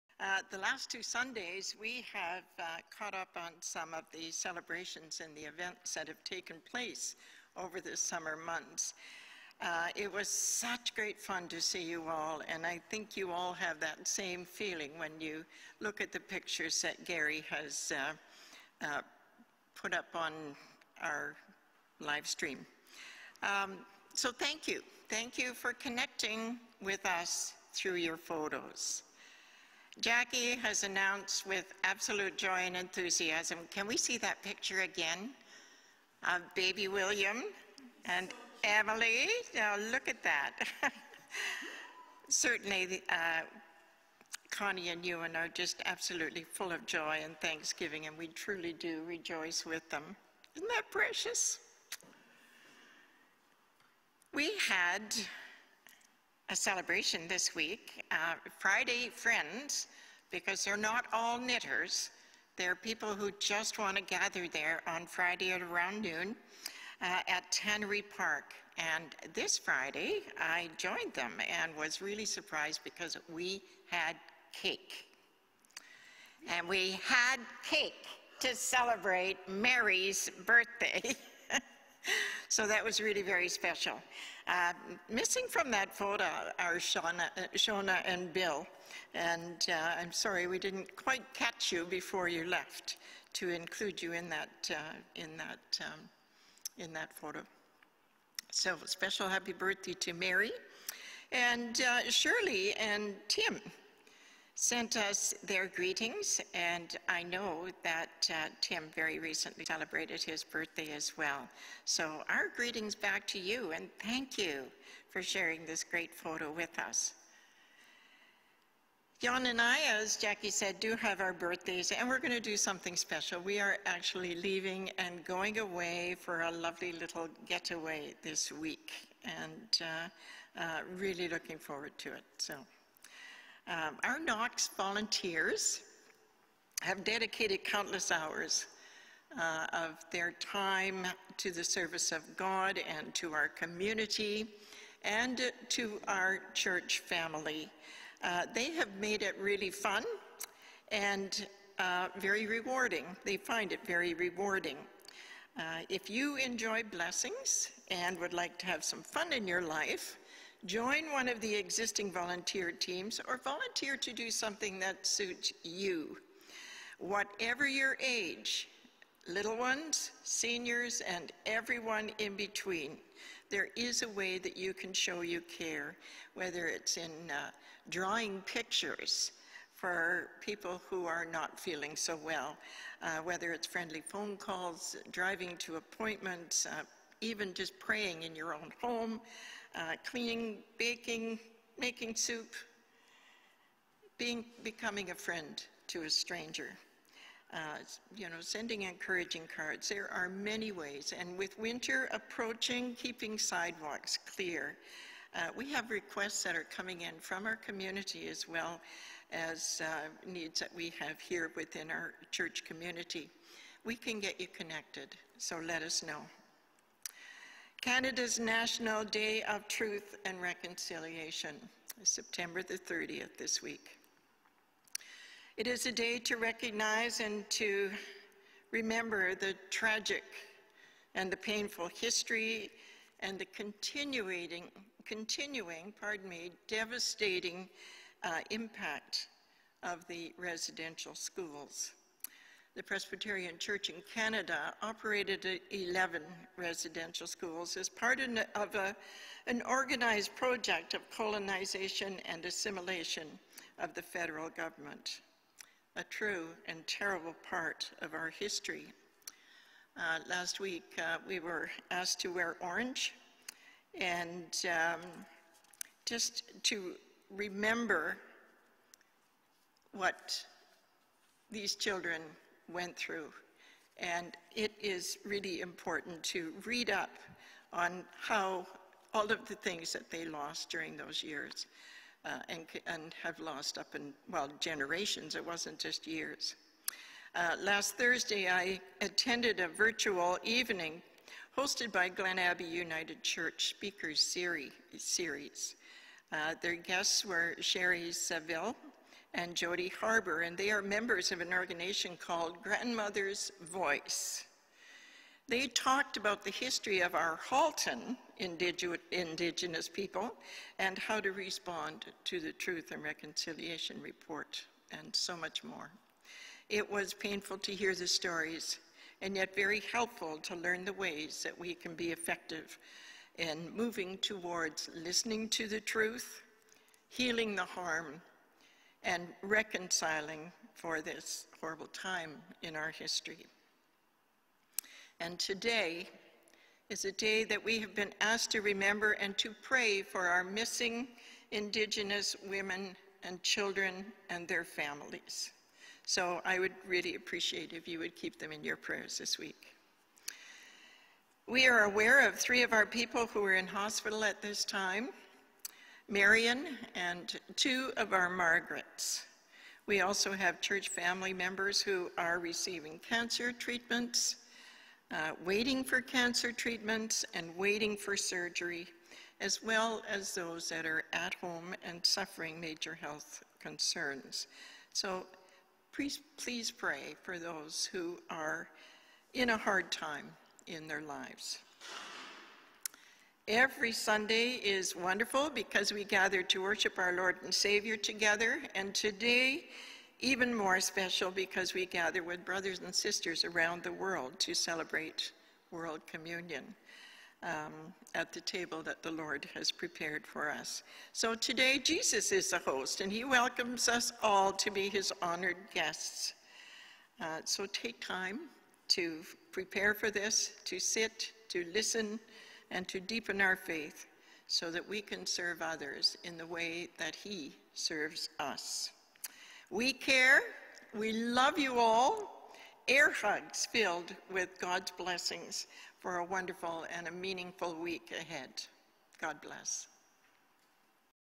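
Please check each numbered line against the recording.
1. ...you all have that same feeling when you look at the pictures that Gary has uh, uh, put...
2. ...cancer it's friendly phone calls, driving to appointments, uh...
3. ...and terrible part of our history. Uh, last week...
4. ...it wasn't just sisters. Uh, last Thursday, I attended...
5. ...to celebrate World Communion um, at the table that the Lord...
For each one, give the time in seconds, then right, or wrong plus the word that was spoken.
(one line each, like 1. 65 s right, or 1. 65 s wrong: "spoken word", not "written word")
1. 13 s right
2. 183 s wrong: "whether", not "cancer"
3. 256 s right
4. 285 s wrong: "years", not "sisters"
5. 394 s right.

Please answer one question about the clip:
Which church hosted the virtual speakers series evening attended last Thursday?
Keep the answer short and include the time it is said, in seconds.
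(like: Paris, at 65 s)
Glen Abbey United Church, at 292 s.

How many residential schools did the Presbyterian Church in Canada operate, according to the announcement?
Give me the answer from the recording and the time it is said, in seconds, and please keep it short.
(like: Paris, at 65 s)
11, at 245 s.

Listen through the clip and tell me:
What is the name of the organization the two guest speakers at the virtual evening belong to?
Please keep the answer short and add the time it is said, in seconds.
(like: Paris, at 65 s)
Grandmother's Voice, at 302 s.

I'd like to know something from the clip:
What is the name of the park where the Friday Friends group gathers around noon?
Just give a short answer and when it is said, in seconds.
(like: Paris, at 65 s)
Tannery Park, at 67 s.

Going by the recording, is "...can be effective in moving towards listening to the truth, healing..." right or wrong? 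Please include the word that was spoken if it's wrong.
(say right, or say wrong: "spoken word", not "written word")
right.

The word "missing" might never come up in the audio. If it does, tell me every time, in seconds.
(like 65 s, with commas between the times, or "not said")
85 s, 340 s.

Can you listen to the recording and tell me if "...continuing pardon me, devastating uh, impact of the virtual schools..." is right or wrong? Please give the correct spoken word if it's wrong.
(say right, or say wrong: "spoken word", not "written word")
wrong: "residential", not "virtual".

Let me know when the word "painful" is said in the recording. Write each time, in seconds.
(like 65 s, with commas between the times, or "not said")
231 s, 317 s.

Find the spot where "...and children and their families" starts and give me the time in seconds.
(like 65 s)
343 s.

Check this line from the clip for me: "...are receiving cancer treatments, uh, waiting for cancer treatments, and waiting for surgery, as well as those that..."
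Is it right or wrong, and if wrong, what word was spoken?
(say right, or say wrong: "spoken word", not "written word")
right.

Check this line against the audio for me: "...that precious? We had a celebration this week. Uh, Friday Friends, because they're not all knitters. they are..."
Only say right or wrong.
right.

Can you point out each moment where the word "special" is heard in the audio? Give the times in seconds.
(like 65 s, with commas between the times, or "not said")
83 s, 98 s, 122 s, 390 s.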